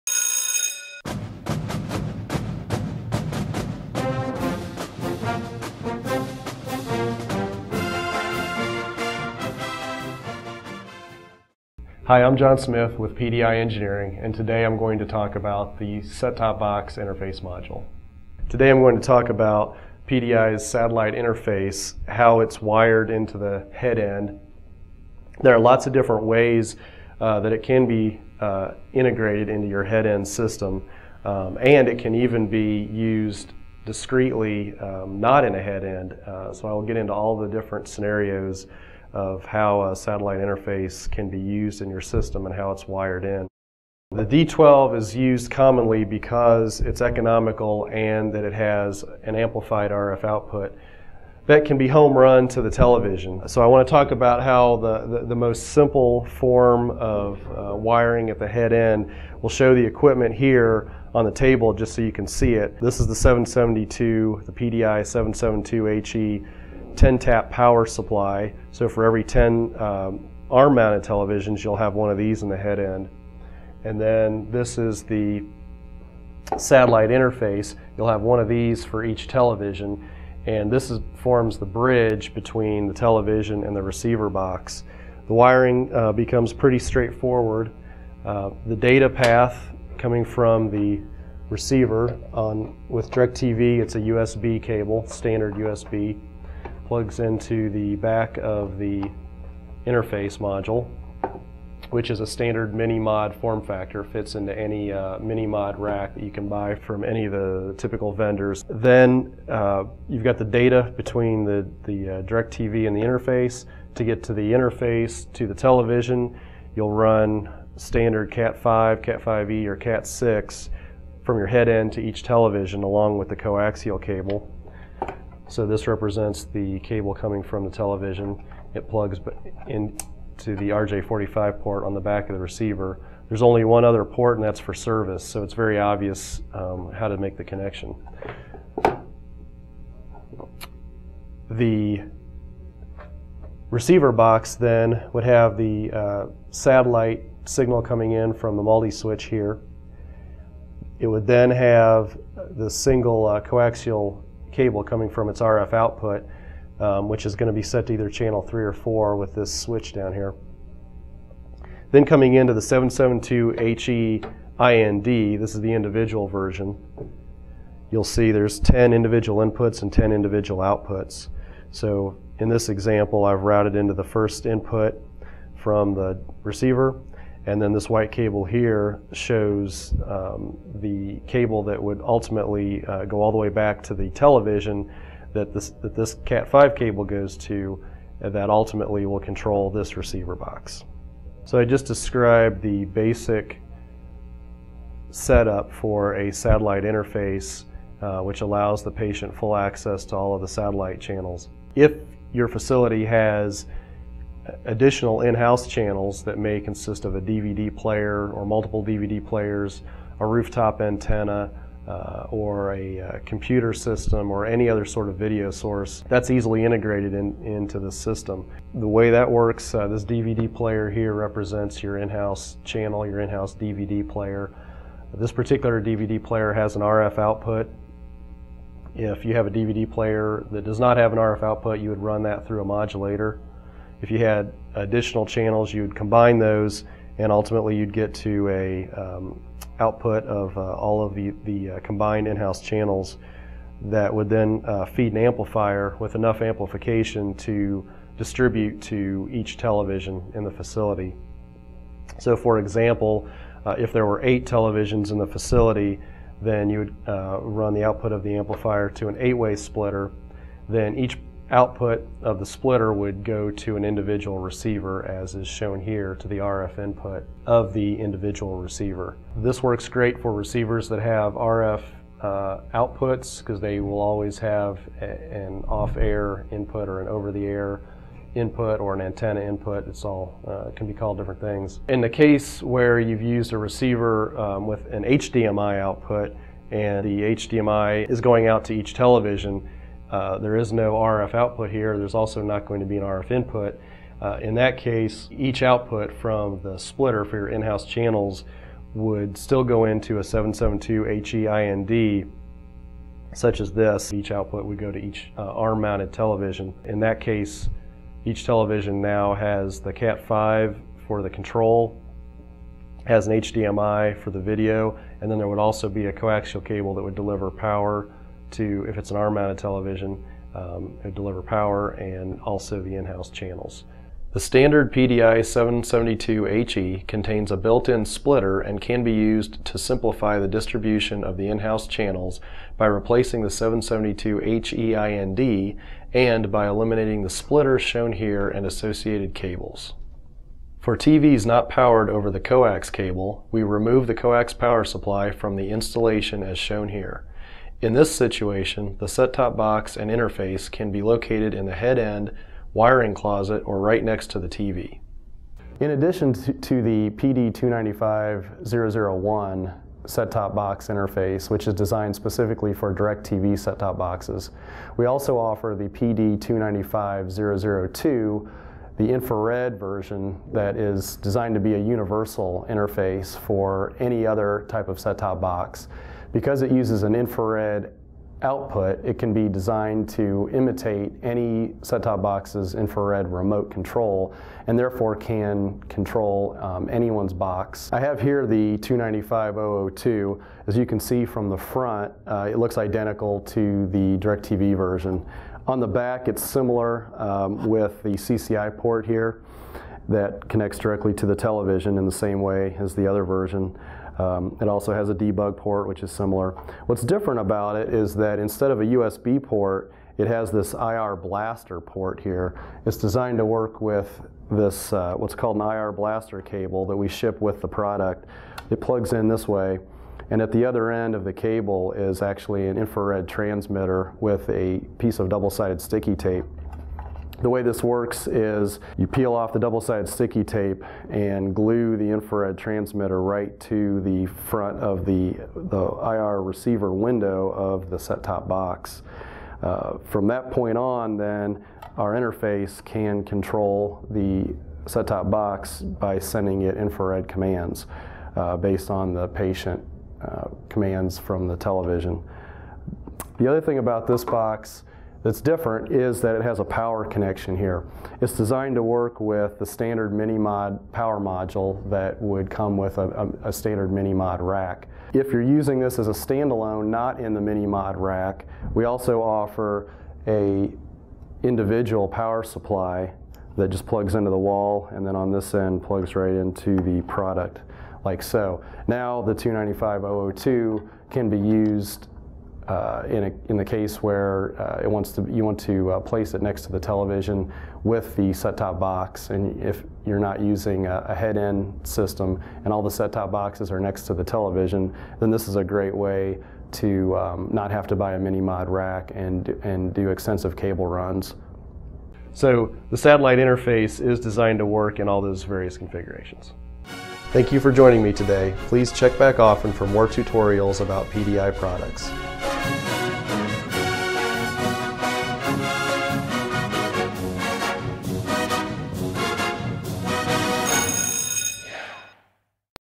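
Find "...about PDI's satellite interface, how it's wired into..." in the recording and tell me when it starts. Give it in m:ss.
0:19.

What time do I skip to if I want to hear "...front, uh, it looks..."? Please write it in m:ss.
6:31.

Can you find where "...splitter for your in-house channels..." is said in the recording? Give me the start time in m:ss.
4:56.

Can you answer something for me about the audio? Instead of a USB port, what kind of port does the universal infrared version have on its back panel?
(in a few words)
IR blaster port.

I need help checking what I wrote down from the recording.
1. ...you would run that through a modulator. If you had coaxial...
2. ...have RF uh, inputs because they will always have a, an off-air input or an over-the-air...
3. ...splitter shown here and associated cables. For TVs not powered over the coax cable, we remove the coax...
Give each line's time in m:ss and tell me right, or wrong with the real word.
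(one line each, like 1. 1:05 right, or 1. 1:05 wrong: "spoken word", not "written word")
1. 3:51 wrong: "additional", not "coaxial"
2. 4:31 wrong: "outputs", not "inputs"
3. 5:37 right.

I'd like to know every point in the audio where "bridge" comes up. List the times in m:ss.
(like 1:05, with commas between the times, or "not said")
1:21.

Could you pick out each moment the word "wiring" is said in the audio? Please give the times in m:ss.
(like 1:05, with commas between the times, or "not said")
0:57, 1:25, 5:52.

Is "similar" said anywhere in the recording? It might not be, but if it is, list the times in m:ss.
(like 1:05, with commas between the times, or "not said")
6:36, 6:46.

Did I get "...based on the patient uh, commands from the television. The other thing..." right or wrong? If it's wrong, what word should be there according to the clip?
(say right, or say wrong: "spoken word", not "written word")
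right.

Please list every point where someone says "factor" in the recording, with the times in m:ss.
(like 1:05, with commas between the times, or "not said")
1:43.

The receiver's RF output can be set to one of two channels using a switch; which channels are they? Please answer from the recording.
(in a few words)
3 or 4.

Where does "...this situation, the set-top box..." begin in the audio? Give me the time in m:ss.
5:47.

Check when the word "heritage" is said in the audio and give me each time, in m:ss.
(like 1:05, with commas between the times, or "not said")
not said.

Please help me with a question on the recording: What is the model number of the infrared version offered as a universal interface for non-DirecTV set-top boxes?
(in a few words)
PD295002.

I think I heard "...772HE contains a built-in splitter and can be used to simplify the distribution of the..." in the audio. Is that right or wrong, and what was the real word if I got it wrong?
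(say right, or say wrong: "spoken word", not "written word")
right.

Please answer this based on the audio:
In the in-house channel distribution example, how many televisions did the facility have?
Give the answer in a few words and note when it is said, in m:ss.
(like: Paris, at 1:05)
8, at 4:14.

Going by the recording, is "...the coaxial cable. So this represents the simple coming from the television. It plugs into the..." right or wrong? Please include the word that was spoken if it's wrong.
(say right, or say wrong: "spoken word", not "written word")
wrong: "cable", not "simple".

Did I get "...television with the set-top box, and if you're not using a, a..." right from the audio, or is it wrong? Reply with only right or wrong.
right.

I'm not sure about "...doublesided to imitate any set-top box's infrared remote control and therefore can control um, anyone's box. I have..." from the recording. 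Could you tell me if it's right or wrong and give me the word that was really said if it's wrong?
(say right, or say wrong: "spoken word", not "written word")
wrong: "designed", not "doublesided".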